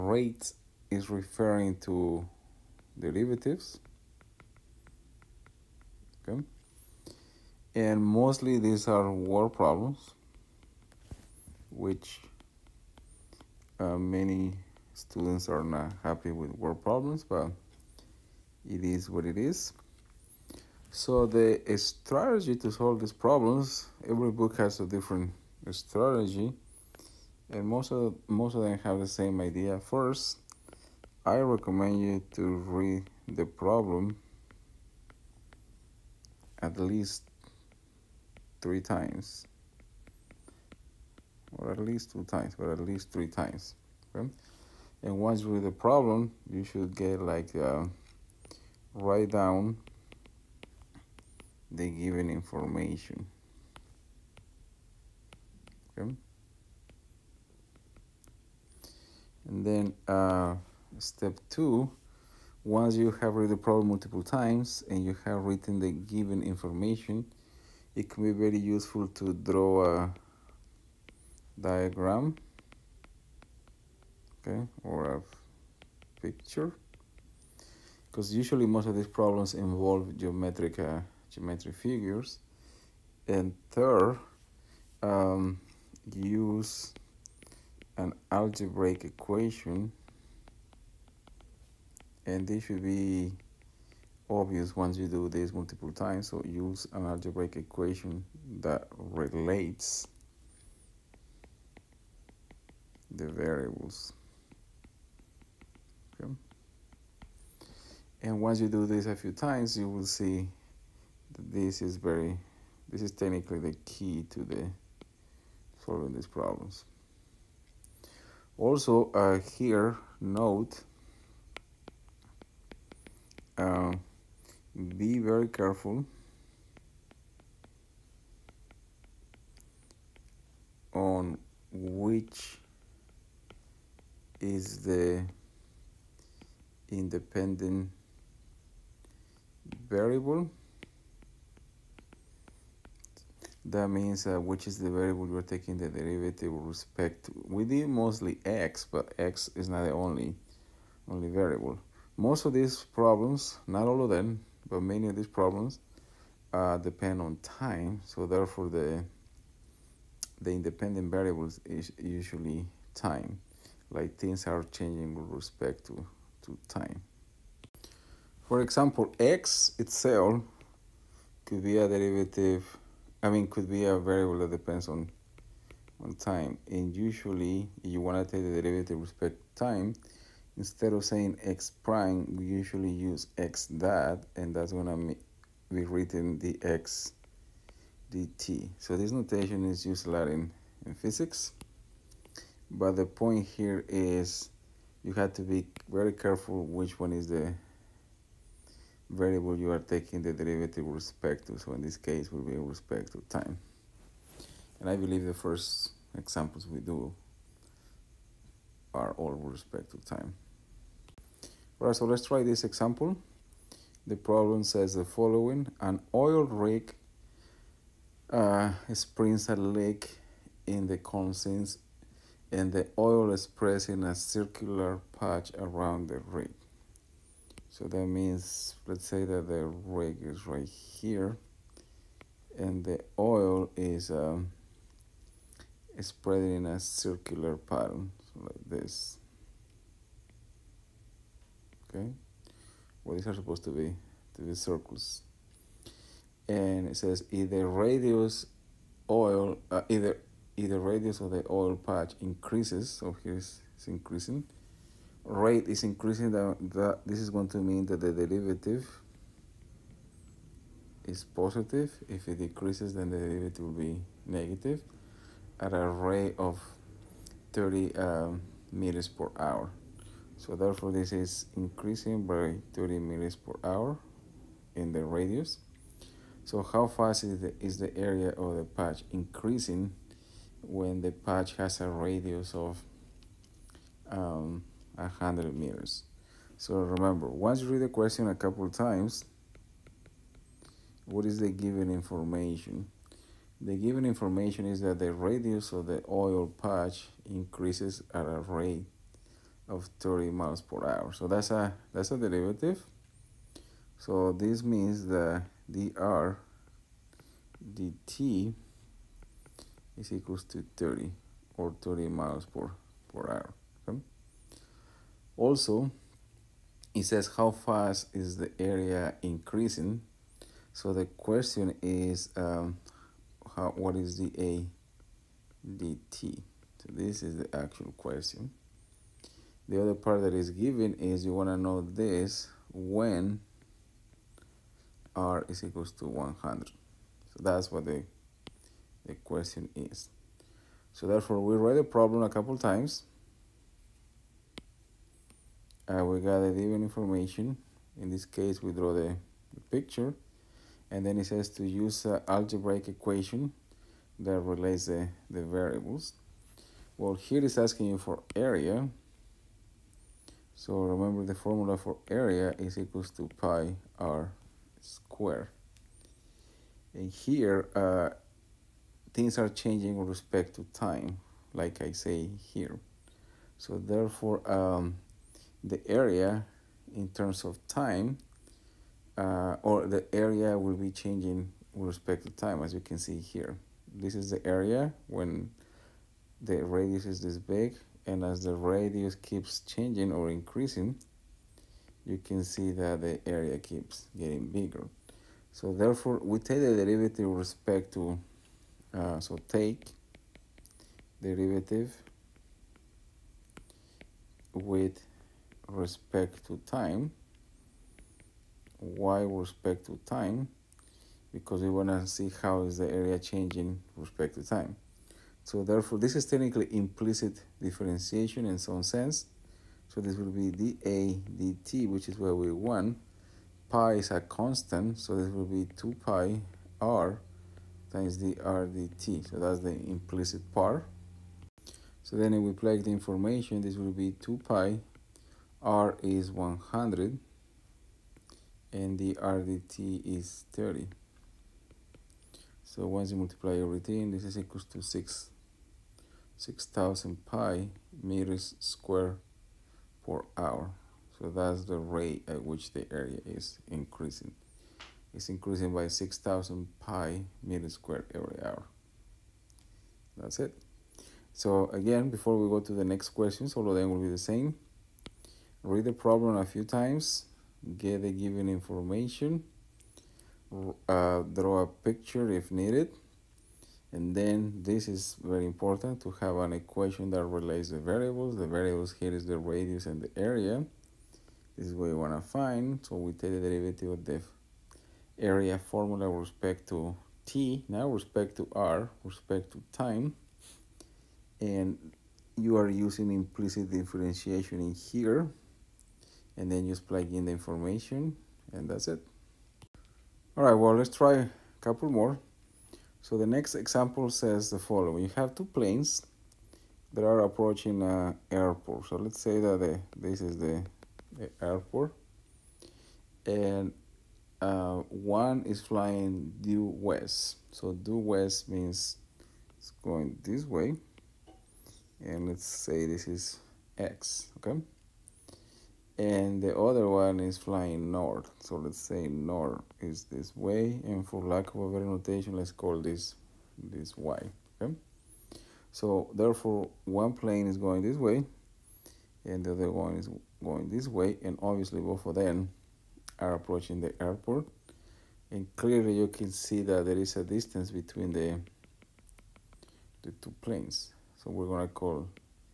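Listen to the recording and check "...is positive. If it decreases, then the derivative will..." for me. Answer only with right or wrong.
right.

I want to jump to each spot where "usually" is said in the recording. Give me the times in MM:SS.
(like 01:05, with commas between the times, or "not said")
01:18, 02:41, 02:56, 03:02.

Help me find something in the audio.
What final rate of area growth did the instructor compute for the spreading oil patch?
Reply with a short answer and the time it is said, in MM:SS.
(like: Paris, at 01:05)
6,000 pi square meters per hour, at 07:26.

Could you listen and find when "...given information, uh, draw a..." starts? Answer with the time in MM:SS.
07:48.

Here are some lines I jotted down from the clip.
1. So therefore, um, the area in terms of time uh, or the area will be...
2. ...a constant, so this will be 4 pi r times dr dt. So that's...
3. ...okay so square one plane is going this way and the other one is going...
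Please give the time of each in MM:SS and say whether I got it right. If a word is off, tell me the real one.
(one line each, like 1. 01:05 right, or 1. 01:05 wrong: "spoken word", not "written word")
1. 06:13 right
2. 07:04 wrong: "2", not "4"
3. 08:54 wrong: "therefore", not "square".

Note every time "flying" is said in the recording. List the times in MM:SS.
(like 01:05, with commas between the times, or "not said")
08:35, 08:47.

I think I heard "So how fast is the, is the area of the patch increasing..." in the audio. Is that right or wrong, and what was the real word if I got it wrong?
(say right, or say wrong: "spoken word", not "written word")
right.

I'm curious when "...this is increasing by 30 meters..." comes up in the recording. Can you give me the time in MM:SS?
04:30.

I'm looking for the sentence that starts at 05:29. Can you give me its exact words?
The other part that is given is you want to know this when r is equals to 100.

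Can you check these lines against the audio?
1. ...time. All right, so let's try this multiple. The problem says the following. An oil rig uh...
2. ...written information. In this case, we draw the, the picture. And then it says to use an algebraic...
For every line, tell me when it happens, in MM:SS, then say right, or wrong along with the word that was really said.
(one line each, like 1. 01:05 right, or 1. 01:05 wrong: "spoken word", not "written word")
1. 03:30 wrong: "example", not "multiple"
2. 05:46 wrong: "given", not "written".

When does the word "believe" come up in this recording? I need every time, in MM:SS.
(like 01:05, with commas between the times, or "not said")
03:24.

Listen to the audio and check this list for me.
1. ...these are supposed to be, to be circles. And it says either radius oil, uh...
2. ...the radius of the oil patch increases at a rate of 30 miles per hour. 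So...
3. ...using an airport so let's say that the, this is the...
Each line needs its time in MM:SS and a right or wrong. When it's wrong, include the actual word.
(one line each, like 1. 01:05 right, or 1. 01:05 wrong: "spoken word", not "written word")
1. 04:03 right
2. 04:54 right
3. 08:27 wrong: "approaching", not "using".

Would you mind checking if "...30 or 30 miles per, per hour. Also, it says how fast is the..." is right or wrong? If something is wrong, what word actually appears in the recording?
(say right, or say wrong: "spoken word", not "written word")
right.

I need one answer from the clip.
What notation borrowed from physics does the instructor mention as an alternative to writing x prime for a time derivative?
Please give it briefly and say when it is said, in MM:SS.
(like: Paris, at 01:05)
x dot, at 03:03.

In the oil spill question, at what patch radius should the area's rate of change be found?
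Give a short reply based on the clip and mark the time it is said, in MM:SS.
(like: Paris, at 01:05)
100 meters, at 04:44.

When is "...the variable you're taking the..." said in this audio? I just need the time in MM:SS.
02:24.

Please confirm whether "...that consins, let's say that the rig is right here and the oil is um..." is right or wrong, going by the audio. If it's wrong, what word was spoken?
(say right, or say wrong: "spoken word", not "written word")
wrong: "means", not "consins".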